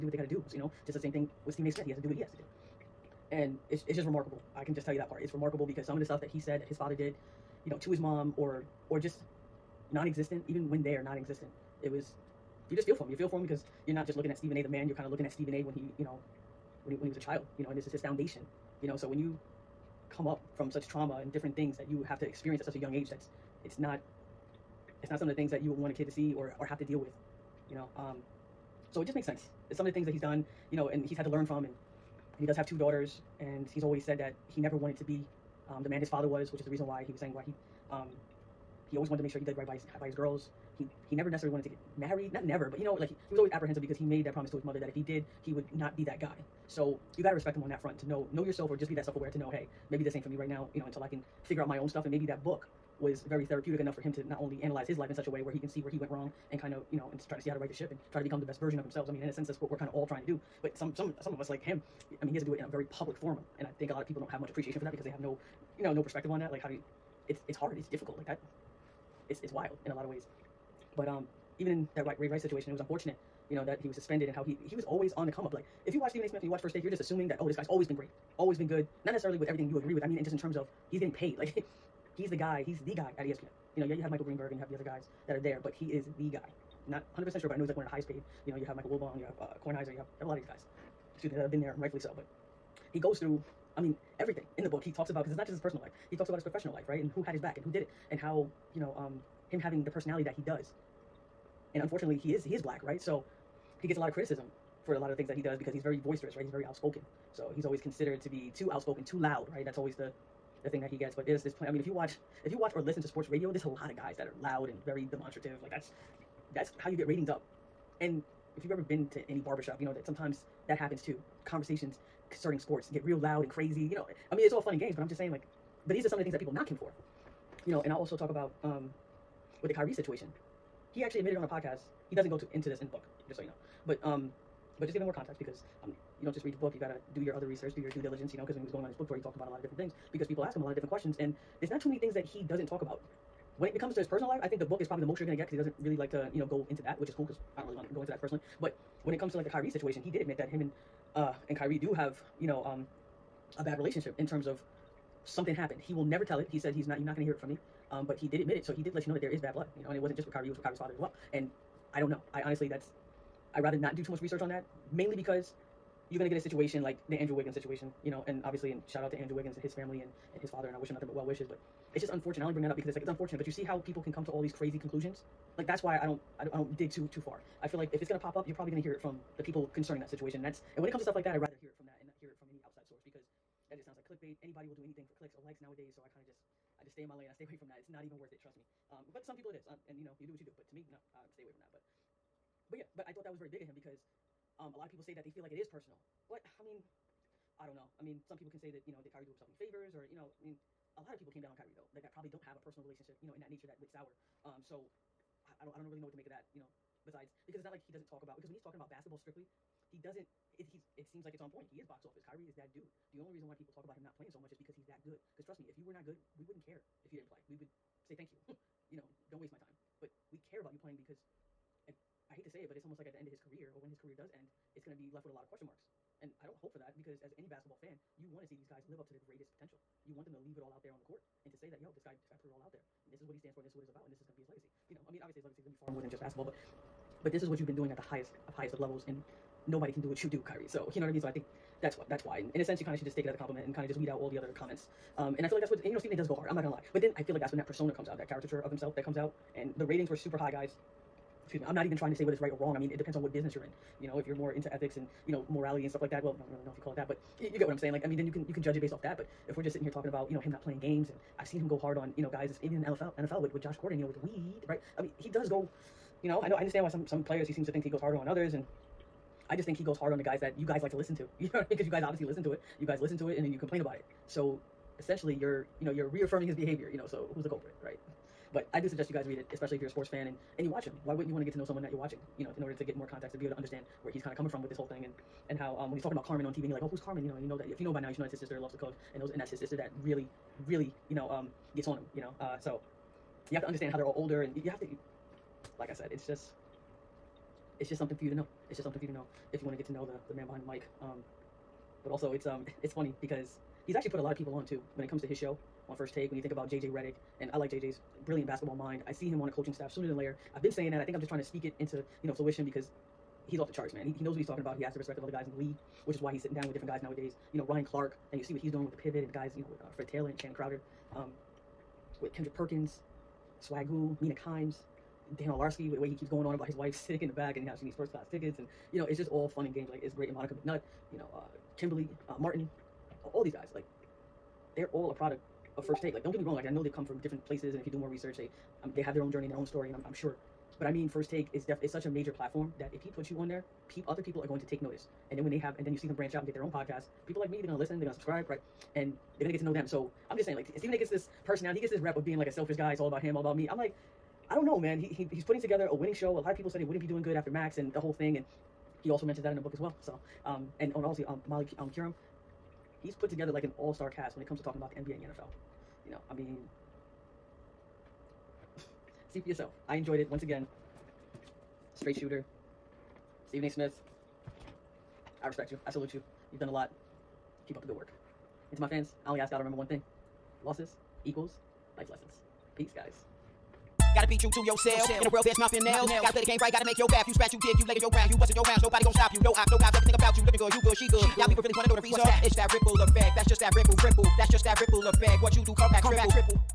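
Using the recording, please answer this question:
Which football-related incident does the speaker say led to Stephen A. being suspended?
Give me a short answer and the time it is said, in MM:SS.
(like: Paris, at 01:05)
Ray Rice situation, at 01:12.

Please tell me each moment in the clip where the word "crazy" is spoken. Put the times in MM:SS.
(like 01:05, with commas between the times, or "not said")
02:03, 02:54.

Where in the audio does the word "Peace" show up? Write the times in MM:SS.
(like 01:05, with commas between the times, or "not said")
06:22.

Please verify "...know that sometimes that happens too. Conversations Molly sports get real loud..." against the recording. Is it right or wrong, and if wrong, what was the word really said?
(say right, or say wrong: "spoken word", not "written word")
wrong: "Certain", not "Molly".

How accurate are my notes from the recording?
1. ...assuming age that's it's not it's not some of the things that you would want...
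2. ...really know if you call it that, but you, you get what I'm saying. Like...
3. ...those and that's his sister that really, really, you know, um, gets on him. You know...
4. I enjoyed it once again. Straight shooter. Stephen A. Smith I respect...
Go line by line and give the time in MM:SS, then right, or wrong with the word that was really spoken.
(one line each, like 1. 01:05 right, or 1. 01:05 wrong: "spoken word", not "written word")
1. 00:22 wrong: "young", not "assuming"
2. 04:16 right
3. 04:49 right
4. 06:09 right.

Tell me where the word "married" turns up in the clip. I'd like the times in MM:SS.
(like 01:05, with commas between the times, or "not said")
00:41.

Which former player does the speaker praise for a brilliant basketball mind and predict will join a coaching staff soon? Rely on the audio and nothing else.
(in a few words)
JJ Redick.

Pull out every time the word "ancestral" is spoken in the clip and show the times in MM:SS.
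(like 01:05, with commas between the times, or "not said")
not said.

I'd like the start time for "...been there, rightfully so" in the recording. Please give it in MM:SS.
01:31.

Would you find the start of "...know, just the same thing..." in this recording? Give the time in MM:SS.
00:00.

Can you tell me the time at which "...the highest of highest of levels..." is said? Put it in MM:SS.
03:57.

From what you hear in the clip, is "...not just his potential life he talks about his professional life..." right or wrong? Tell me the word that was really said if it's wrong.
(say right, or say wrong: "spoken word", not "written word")
wrong: "personal", not "potential".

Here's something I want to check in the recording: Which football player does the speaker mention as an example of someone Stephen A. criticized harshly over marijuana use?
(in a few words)
Josh Gordon.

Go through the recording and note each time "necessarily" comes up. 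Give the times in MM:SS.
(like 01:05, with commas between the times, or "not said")
00:41, 01:19.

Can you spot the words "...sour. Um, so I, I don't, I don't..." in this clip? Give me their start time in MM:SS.
03:23.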